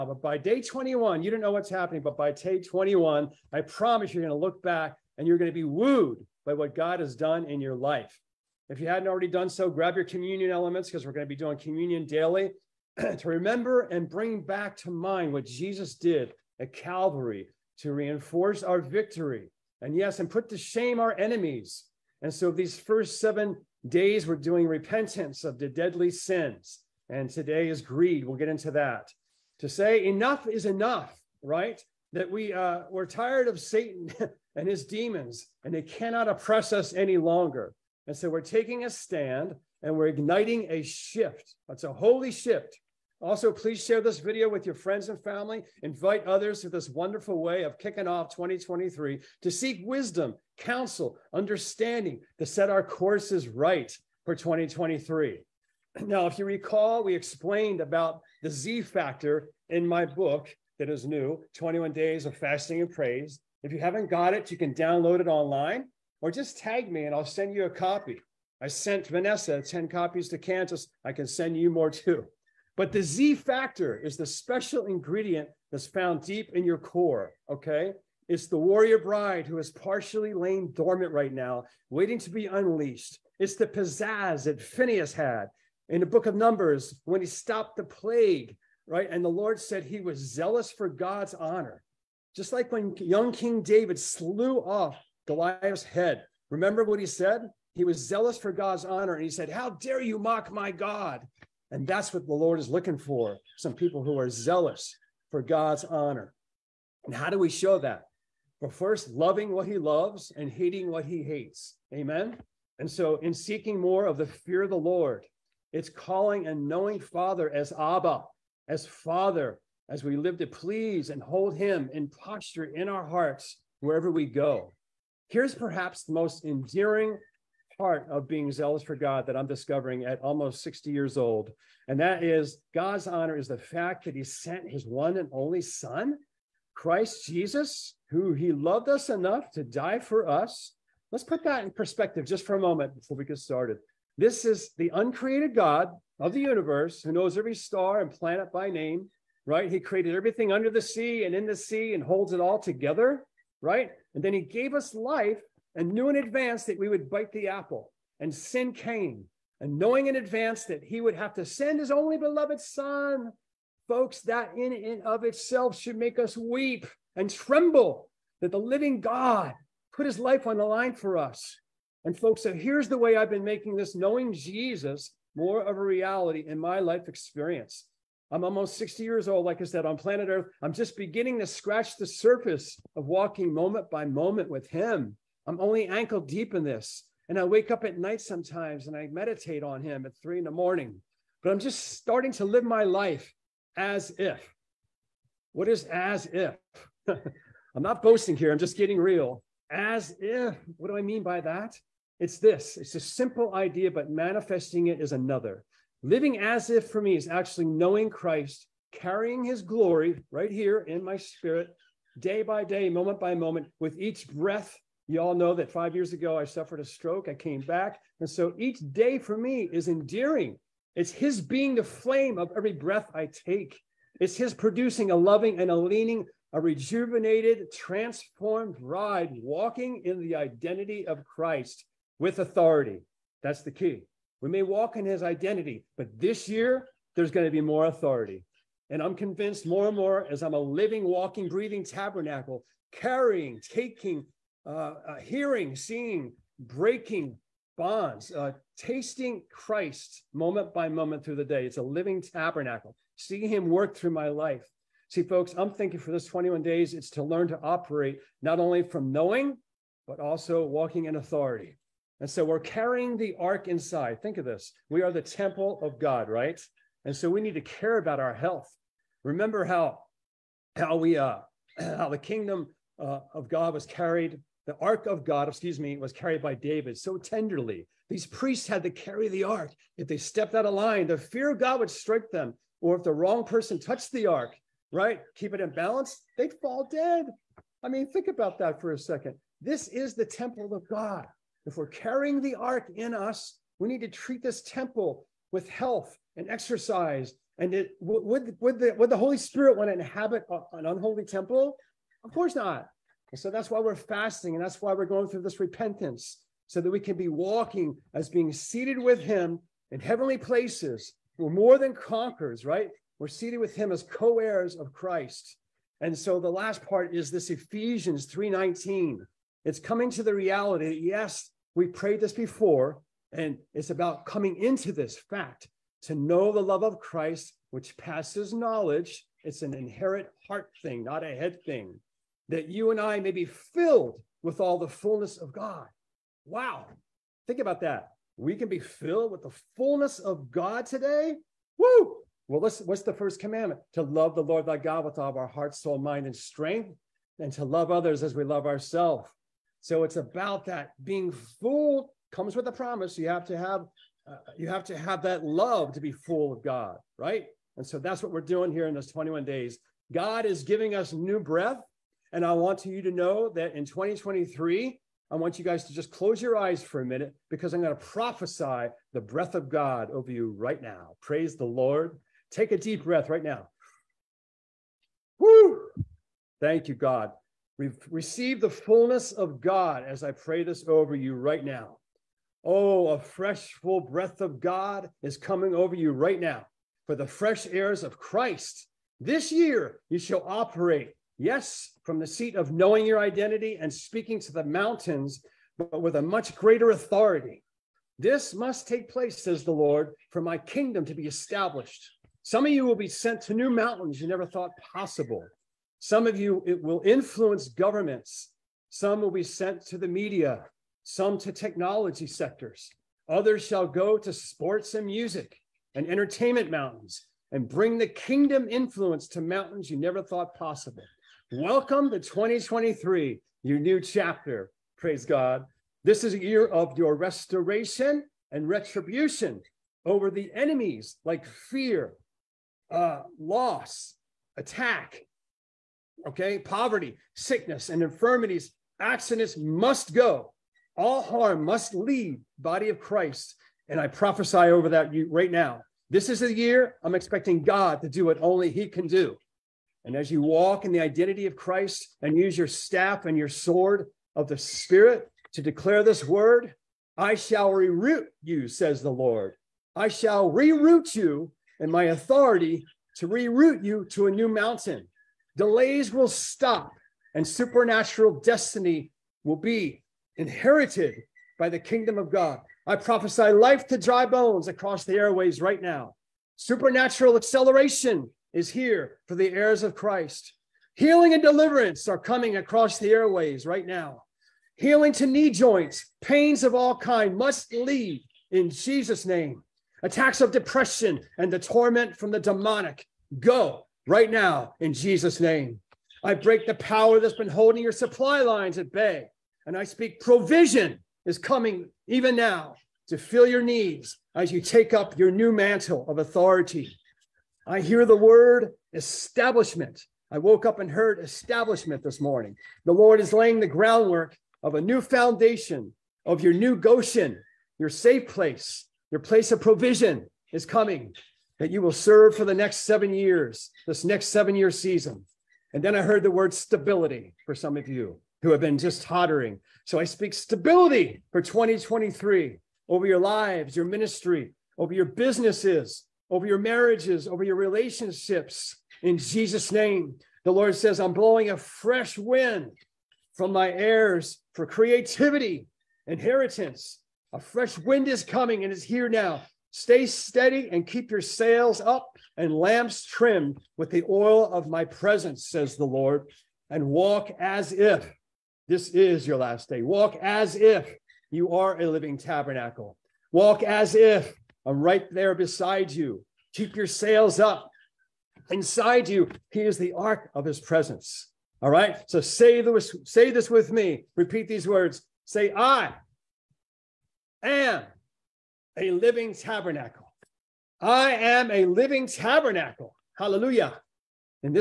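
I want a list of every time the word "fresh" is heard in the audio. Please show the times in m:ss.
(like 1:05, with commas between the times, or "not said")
6:23, 6:27, 9:01, 9:07.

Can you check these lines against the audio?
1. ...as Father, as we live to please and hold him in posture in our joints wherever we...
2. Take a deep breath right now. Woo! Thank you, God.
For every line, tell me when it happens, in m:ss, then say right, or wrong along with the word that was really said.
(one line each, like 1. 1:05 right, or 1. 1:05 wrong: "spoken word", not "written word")
1. 1:58 wrong: "hearts", not "joints"
2. 6:12 right.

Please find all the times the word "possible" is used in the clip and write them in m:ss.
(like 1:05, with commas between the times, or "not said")
6:44, 7:00.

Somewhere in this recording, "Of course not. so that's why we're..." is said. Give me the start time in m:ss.
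5:02.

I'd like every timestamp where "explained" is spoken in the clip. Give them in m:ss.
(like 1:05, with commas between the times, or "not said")
0:57.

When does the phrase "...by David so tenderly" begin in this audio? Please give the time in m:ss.
4:36.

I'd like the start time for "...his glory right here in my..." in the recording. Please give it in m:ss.
3:29.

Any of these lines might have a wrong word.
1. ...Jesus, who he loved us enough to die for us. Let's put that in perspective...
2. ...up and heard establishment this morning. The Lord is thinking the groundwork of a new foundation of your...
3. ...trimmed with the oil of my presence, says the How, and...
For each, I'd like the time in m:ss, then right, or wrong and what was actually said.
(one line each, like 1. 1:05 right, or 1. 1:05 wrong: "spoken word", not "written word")
1. 2:17 right
2. 8:30 wrong: "laying", not "thinking"
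3. 9:13 wrong: "Lord", not "How".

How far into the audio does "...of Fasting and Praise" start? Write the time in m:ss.
1:02.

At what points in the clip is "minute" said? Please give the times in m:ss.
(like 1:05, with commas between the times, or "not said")
6:07.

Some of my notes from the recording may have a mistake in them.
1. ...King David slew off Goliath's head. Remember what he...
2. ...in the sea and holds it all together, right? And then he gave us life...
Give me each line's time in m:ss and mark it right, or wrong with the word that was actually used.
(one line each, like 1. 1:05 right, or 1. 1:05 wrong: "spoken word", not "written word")
1. 1:33 right
2. 2:31 right.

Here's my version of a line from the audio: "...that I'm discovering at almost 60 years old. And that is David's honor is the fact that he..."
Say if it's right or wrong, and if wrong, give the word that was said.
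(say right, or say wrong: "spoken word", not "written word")
wrong: "God", not "David".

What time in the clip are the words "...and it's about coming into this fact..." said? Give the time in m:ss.
5:23.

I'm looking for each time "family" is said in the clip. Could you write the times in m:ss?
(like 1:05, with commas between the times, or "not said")
0:45.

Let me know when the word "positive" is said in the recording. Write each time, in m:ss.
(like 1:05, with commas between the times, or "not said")
not said.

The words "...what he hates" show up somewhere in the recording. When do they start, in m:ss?
1:50.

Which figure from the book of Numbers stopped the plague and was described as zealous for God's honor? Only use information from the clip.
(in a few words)
Phineas.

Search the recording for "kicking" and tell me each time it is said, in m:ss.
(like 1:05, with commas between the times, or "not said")
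0:47.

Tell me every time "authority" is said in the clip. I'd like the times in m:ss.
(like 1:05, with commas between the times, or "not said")
3:52, 3:57, 4:21, 6:36, 7:42, 8:26.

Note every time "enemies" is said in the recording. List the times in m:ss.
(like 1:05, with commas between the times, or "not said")
0:21, 7:10.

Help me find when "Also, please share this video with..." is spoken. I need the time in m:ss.
0:43.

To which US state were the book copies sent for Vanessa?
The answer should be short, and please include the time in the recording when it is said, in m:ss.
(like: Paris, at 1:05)
Kansas, at 1:10.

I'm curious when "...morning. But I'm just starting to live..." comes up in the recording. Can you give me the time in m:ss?
3:10.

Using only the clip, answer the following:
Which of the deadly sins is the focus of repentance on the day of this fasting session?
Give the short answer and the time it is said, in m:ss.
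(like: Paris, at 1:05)
Greed, at 0:27.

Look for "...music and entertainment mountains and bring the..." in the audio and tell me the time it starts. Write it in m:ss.
6:55.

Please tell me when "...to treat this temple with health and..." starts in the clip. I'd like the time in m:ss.
4:54.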